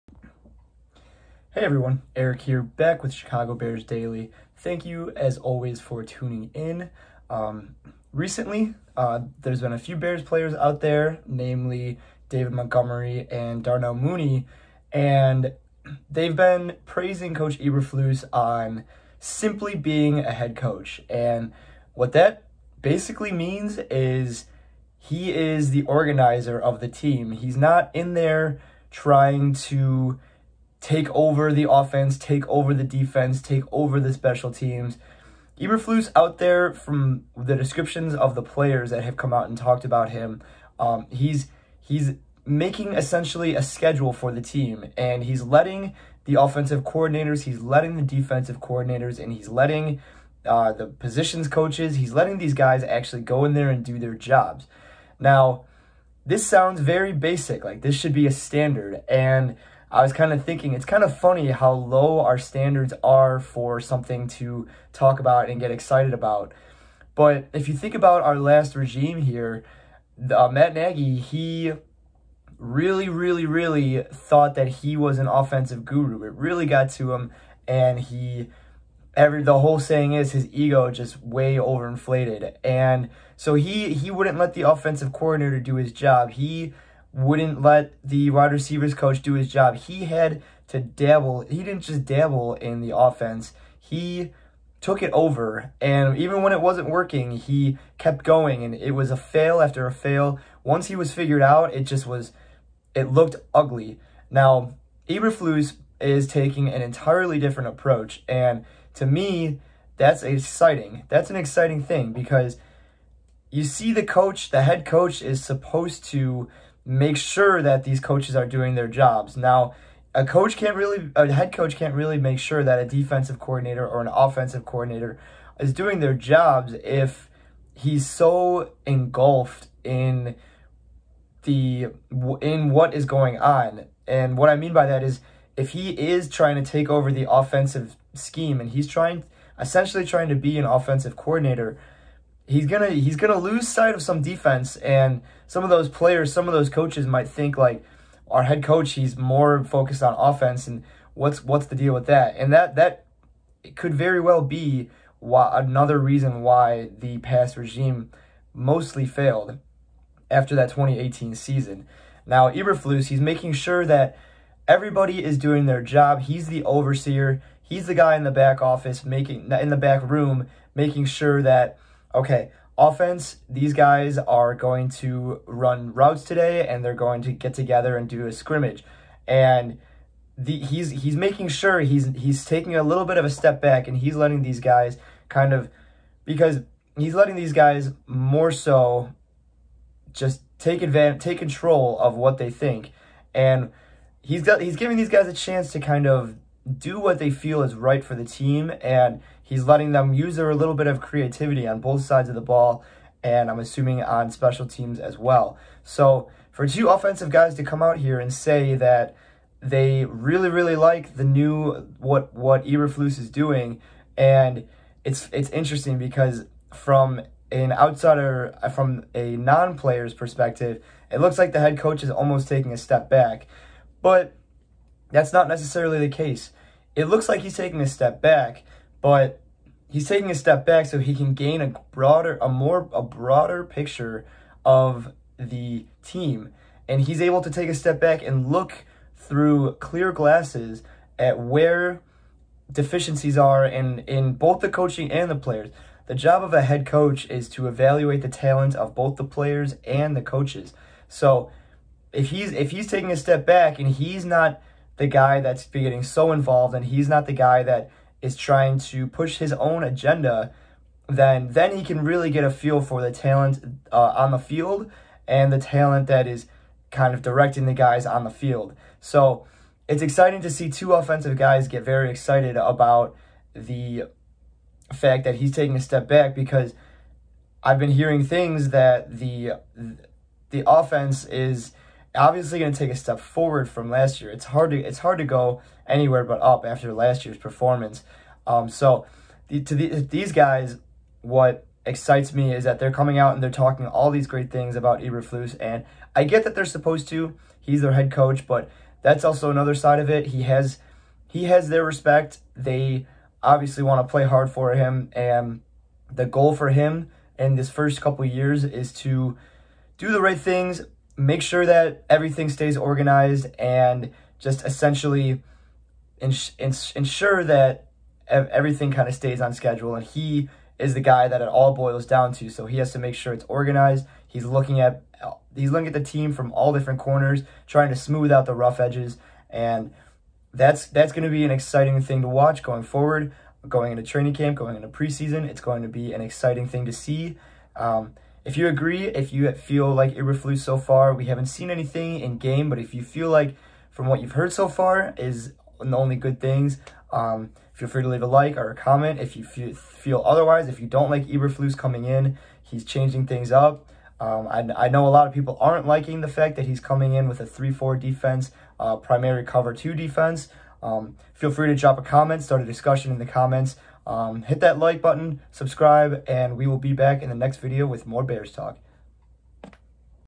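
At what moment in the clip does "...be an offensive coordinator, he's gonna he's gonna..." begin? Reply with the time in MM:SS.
02:20.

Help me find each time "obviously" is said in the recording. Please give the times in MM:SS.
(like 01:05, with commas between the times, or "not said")
04:42, 05:03.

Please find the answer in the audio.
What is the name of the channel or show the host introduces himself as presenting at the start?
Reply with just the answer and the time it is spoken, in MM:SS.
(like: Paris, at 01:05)
Chicago Bears Daily, at 00:03.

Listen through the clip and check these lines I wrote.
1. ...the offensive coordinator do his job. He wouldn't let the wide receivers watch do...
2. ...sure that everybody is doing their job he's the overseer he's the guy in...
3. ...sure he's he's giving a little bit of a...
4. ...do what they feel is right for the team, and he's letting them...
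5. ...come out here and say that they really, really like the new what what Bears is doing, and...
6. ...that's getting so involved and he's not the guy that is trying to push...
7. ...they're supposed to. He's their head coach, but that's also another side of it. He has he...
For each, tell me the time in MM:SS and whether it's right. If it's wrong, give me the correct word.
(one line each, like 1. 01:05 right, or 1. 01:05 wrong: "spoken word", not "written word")
1. 01:24 wrong: "coach", not "watch"
2. 02:43 right
3. 03:01 wrong: "taking", not "giving"
4. 03:16 right
5. 03:27 wrong: "Eberflus", not "Bears"
6. 04:15 right
7. 04:56 right.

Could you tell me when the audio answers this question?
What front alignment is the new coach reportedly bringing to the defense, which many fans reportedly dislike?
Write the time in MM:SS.
05:57.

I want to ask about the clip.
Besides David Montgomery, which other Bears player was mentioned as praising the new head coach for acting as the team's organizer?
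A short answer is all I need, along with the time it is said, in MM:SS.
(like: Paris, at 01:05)
Darnell Mooney, at 00:13.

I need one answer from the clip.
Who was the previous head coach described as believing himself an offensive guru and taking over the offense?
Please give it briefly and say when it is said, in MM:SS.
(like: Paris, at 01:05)
Matt Nagy, at 01:10.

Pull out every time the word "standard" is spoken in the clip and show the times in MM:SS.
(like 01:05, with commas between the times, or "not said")
00:58, 01:02.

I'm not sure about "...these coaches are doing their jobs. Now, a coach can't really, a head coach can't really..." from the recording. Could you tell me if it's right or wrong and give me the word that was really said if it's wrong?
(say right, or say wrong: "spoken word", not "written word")
right.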